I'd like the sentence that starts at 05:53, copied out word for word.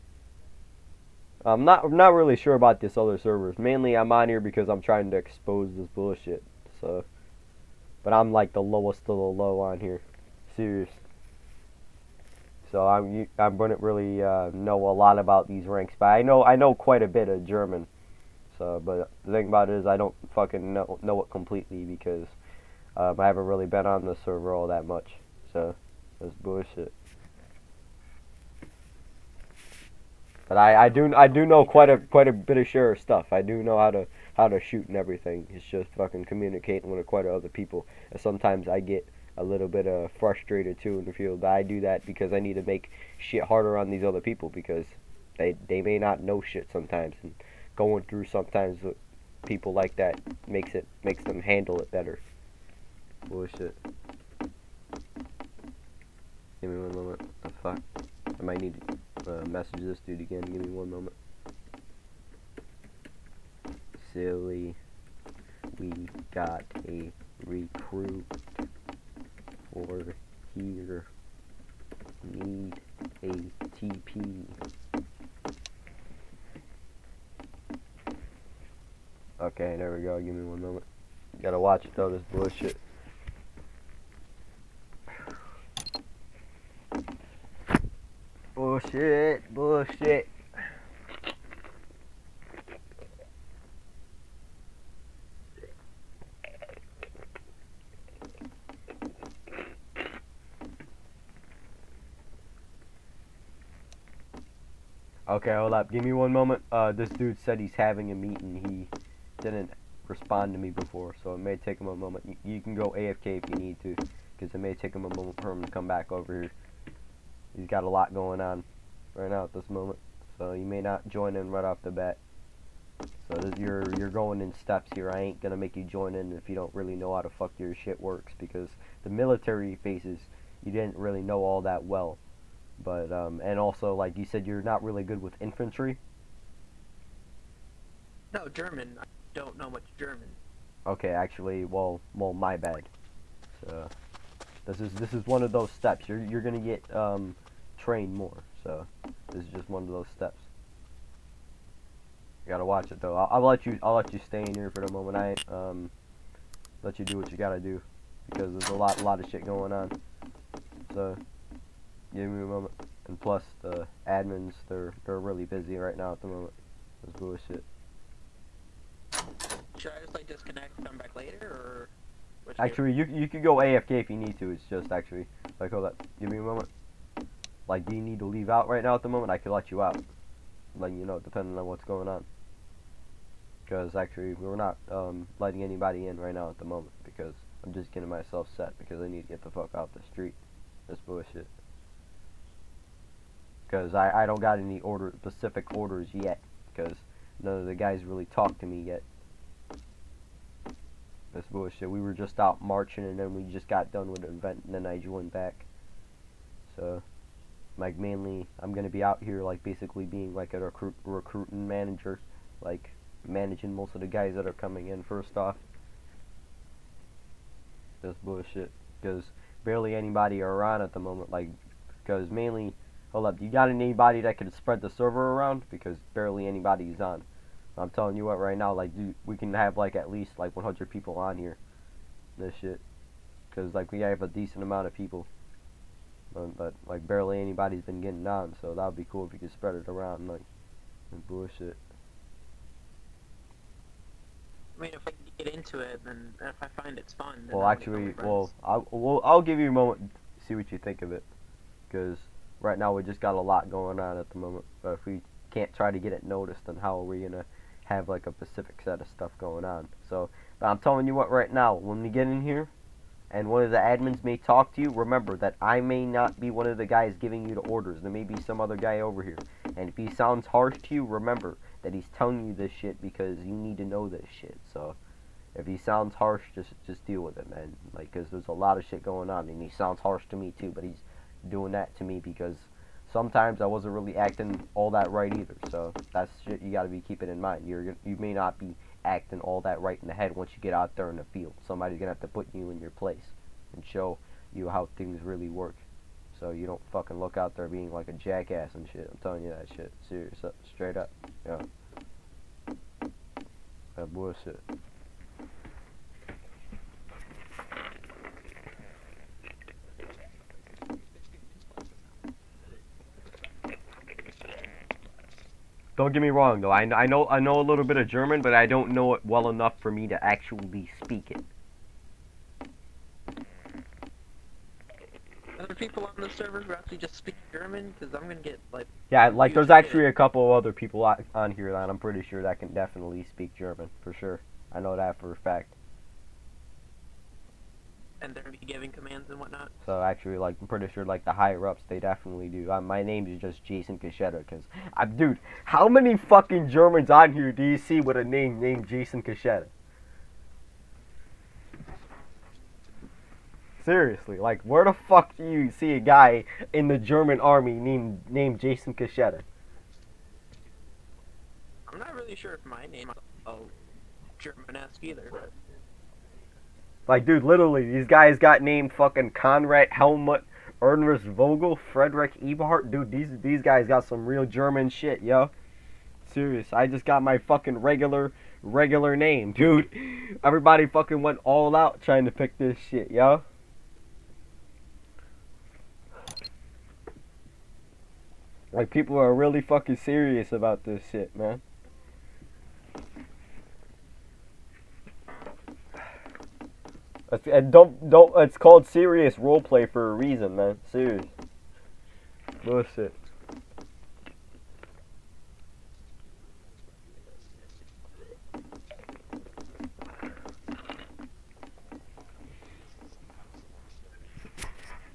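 Seriously, like where the fuck do you see a guy in the German army named named Jason Cachetta?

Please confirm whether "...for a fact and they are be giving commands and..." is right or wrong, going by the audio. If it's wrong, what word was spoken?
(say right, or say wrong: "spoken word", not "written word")
right.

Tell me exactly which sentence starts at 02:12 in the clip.
But um, and also, like you said, you're not really good with infantry.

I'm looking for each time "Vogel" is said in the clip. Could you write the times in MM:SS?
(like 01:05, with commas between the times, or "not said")
06:11.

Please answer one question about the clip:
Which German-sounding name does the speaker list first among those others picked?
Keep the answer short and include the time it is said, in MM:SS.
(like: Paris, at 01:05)
Conrad Helmut, at 06:09.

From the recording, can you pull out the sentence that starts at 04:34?
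So if he sounds harsh, just just deal with it, man.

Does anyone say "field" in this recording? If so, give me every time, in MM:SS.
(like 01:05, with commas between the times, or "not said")
00:41, 04:51.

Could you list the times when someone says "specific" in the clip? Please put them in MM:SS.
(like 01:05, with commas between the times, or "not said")
03:15, 04:18.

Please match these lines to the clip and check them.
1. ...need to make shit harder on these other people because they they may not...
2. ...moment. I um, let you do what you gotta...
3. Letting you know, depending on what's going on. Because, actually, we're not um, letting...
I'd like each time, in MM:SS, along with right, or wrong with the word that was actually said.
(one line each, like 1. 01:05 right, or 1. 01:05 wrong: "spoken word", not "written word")
1. 00:42 right
2. 02:34 right
3. 03:00 right.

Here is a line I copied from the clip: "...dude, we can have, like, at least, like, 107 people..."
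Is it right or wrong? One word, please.
wrong.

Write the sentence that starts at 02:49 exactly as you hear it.
Should I just, like, disconnect and come back later, or...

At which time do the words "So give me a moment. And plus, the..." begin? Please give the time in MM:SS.
02:40.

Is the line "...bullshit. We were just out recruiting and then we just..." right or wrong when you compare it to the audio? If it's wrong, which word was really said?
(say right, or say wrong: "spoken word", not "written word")
wrong: "marching", not "recruiting".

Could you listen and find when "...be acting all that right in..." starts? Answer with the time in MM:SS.
04:48.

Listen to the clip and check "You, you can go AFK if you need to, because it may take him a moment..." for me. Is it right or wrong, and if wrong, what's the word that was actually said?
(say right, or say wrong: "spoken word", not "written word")
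right.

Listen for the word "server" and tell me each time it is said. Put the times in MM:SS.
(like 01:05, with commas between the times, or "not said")
00:03, 00:24, 03:44, 05:26.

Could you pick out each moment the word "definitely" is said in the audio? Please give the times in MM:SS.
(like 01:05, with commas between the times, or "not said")
05:32, 05:41.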